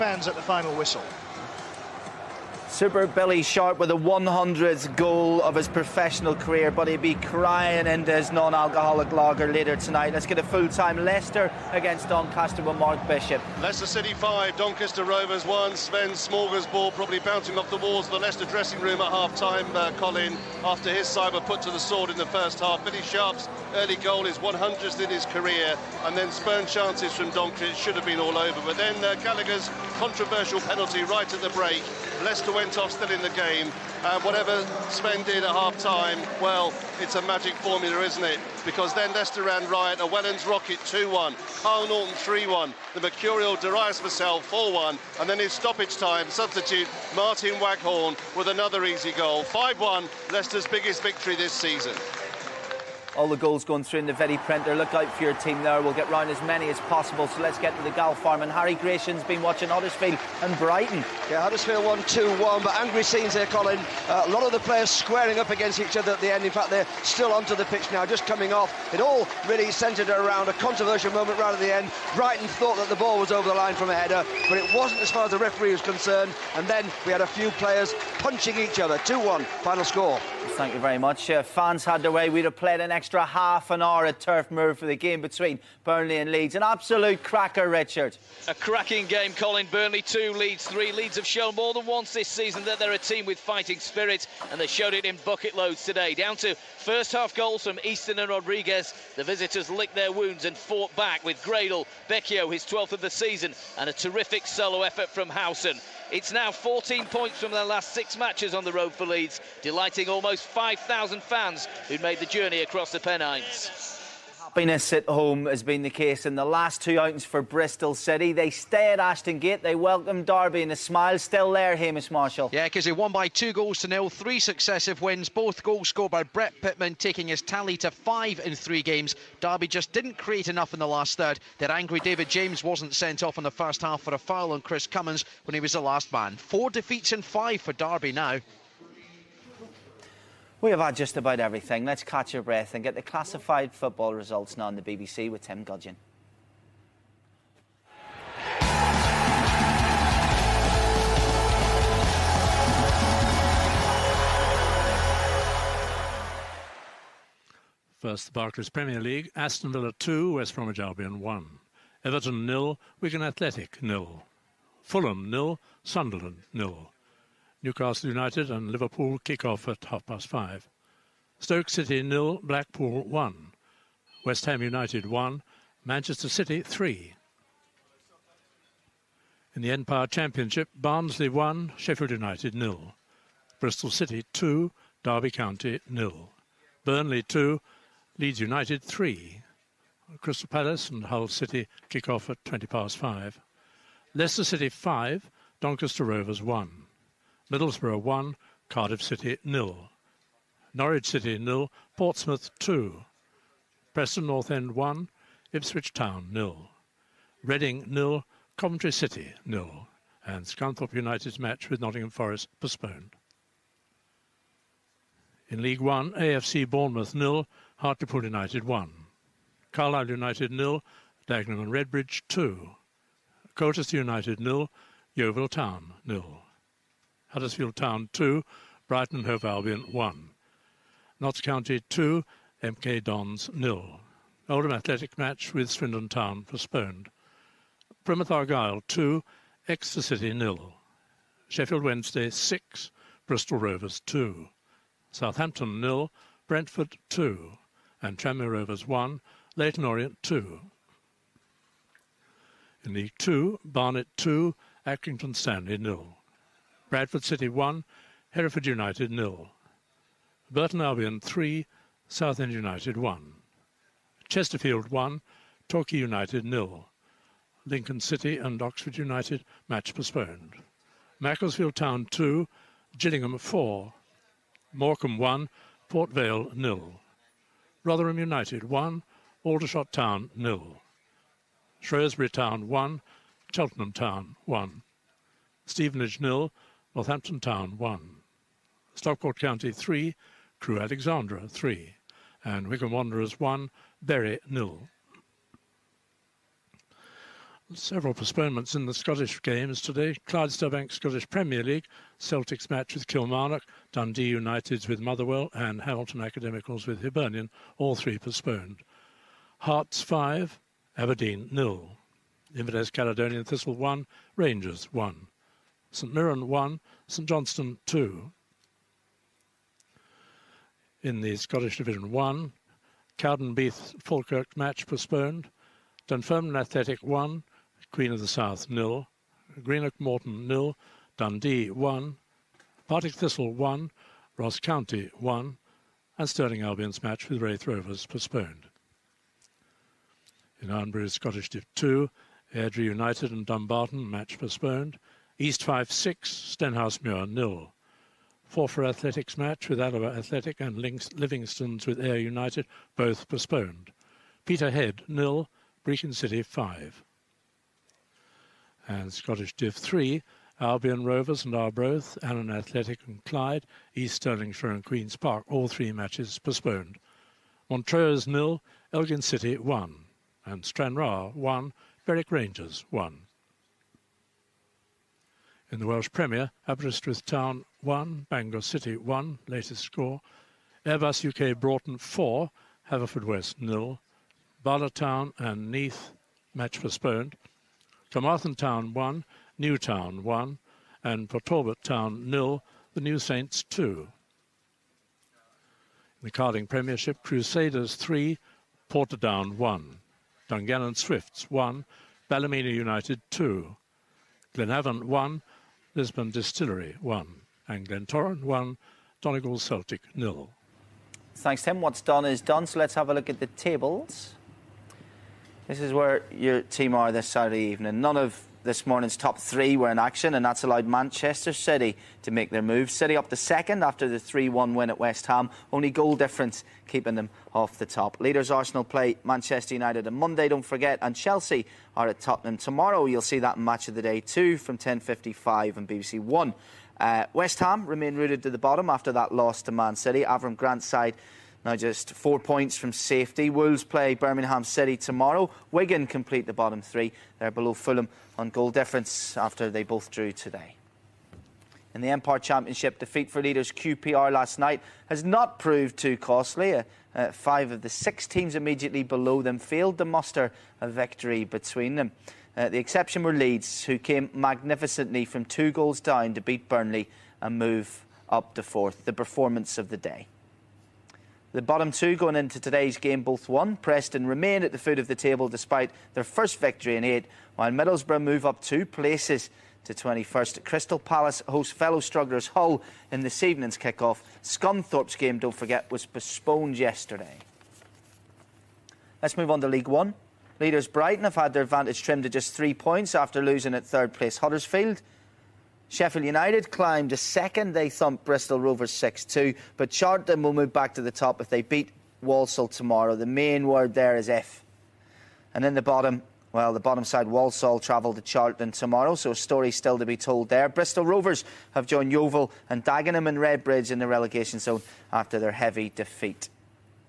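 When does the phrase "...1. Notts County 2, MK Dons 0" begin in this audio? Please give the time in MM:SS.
03:49.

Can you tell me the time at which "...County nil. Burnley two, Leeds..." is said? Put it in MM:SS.
03:05.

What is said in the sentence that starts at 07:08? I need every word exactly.
Leaders Arsenal play Manchester United on Monday, don't forget, and Chelsea are at Tottenham tomorrow.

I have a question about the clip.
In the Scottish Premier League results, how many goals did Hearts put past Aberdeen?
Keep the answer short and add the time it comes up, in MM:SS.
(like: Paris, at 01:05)
5, at 05:09.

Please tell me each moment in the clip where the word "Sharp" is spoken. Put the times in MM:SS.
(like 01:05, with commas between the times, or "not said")
00:03, 00:23.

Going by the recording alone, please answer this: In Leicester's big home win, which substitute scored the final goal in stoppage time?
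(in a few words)
Martin Waghorn.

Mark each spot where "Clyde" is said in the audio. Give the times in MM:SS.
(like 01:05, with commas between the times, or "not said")
05:00, 06:03.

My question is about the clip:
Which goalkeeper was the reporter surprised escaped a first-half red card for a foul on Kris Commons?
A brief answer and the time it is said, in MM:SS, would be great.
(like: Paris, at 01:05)
David James, at 02:11.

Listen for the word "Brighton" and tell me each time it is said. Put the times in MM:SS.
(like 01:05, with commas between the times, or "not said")
01:00, 01:12, 03:48, 08:10.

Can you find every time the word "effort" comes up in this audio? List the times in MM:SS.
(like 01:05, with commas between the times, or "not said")
01:44.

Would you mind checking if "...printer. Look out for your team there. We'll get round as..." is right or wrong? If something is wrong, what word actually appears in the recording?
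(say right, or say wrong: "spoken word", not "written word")
right.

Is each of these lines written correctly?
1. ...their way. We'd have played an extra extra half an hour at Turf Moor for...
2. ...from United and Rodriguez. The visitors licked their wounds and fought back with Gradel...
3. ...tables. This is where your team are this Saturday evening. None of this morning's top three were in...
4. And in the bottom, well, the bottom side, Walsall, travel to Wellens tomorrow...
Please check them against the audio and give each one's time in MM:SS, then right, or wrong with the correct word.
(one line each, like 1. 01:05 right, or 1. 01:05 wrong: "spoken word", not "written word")
1. 01:22 right
2. 01:37 wrong: "Easton", not "United"
3. 06:53 right
4. 08:25 wrong: "Charlton", not "Wellens".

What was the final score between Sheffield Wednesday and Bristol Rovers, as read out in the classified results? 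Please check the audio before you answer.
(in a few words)
6-2.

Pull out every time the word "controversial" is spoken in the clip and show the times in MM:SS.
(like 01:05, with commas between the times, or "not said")
00:29, 01:10.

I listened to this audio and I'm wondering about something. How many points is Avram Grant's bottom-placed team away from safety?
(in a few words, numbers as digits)
4.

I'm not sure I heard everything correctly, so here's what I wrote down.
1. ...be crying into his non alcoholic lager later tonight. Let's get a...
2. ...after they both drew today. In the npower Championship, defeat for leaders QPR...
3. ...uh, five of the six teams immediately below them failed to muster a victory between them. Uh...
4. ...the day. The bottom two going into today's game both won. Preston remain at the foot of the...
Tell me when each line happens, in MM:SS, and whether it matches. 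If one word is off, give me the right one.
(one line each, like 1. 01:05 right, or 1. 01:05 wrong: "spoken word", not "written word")
1. 00:06 right
2. 07:29 right
3. 07:37 right
4. 07:49 right.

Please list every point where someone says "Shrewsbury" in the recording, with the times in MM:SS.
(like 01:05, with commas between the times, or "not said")
04:41.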